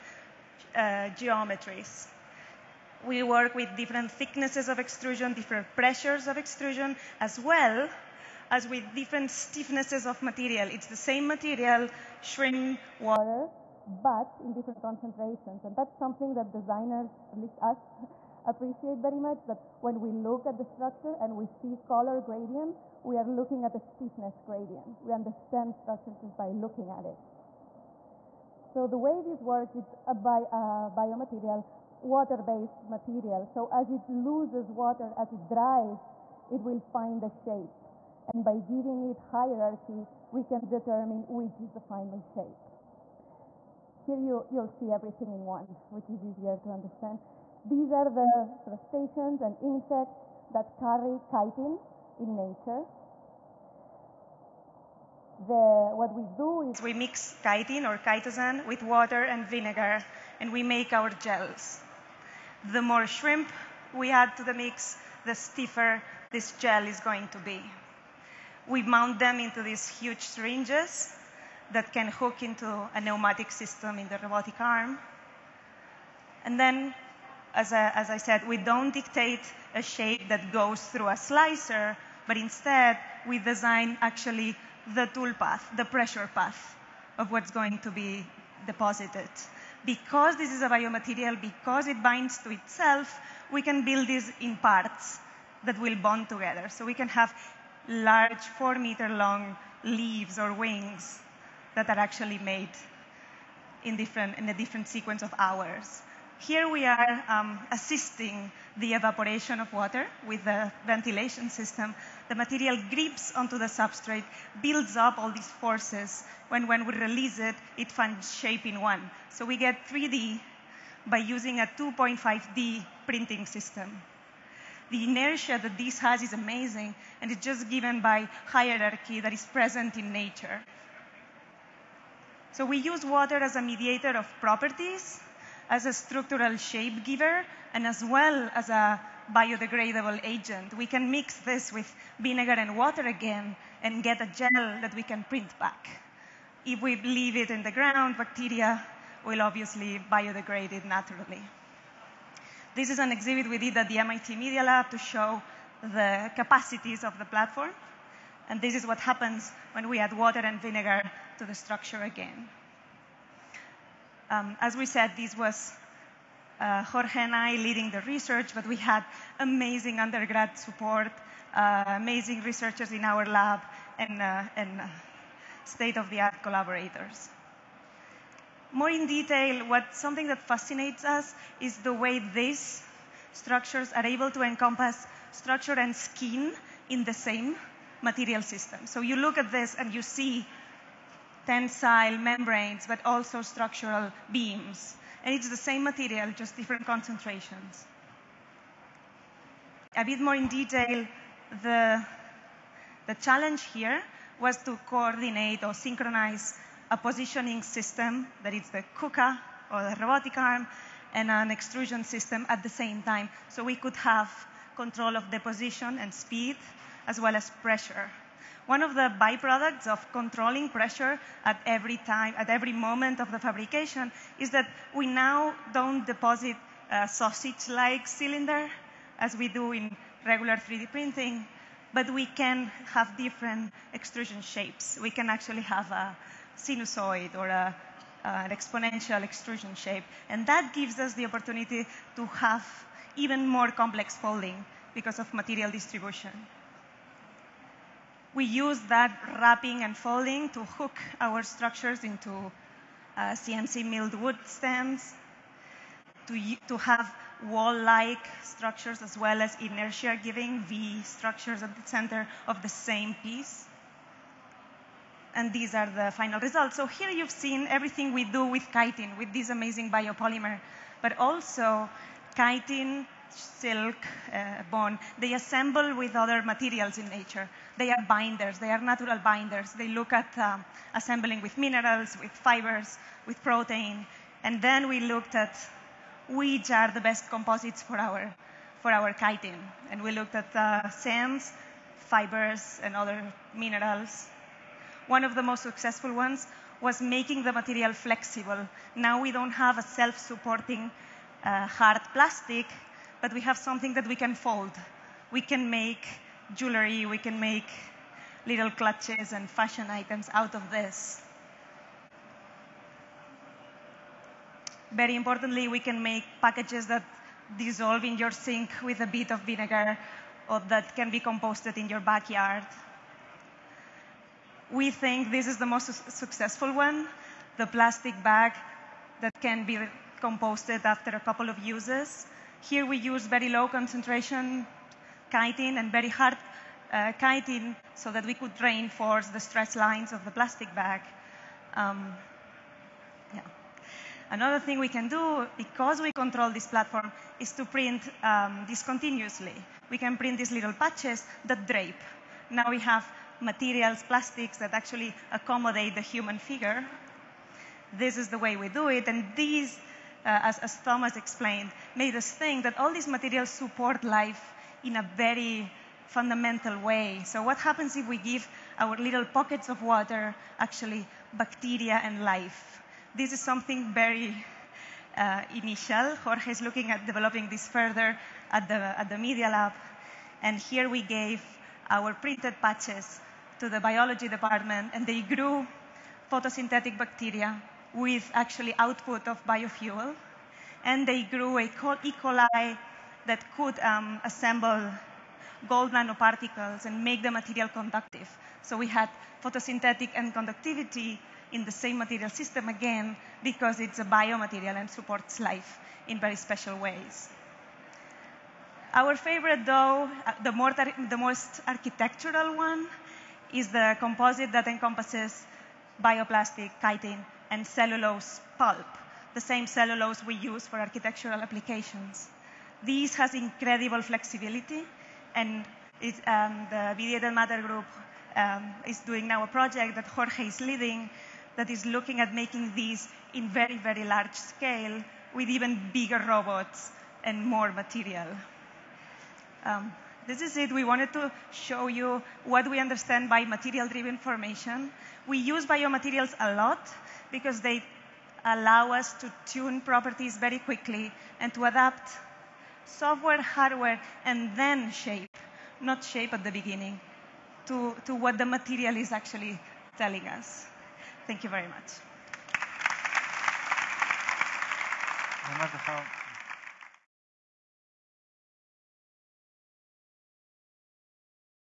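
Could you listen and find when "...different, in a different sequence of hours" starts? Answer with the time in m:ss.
1:43.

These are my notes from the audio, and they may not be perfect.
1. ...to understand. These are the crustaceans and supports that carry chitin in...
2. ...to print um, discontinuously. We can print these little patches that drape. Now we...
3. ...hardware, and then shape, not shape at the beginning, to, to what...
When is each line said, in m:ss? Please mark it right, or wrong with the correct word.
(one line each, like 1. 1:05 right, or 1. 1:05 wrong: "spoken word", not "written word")
1. 0:46 wrong: "insects", not "supports"
2. 5:47 right
3. 7:33 right.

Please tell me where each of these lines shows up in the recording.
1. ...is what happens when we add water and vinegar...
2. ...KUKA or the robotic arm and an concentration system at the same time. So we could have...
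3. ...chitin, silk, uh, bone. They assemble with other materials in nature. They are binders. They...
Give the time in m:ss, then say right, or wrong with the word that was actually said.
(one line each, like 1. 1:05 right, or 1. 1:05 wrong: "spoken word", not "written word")
1. 2:38 right
2. 3:28 wrong: "extrusion", not "concentration"
3. 4:32 right.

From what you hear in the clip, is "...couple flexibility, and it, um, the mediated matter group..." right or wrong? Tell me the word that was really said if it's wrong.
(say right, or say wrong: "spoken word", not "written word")
wrong: "incredible", not "couple".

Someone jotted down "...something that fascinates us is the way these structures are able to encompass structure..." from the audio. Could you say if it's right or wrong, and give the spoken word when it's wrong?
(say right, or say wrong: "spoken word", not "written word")
right.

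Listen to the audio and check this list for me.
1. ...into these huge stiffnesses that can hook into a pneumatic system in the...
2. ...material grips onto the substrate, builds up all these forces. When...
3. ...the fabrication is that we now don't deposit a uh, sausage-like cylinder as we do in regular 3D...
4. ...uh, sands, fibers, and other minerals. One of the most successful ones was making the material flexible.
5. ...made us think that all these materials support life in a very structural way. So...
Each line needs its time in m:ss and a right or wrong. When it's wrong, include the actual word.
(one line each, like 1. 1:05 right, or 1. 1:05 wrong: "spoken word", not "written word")
1. 1:09 wrong: "syringes", not "stiffnesses"
2. 1:52 right
3. 3:43 right
4. 4:50 right
5. 6:01 wrong: "fundamental", not "structural".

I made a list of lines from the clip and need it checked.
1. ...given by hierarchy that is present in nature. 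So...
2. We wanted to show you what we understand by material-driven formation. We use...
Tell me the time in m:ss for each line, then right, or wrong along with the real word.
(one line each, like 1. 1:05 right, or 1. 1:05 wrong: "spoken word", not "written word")
1. 2:07 right
2. 7:20 right.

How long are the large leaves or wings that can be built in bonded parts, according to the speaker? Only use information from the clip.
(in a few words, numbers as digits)
4 meters.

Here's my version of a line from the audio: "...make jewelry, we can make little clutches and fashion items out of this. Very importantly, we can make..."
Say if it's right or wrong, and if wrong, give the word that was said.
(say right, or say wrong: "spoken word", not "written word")
right.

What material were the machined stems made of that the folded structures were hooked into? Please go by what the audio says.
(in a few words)
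Wood.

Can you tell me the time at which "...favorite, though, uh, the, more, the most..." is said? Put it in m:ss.
6:49.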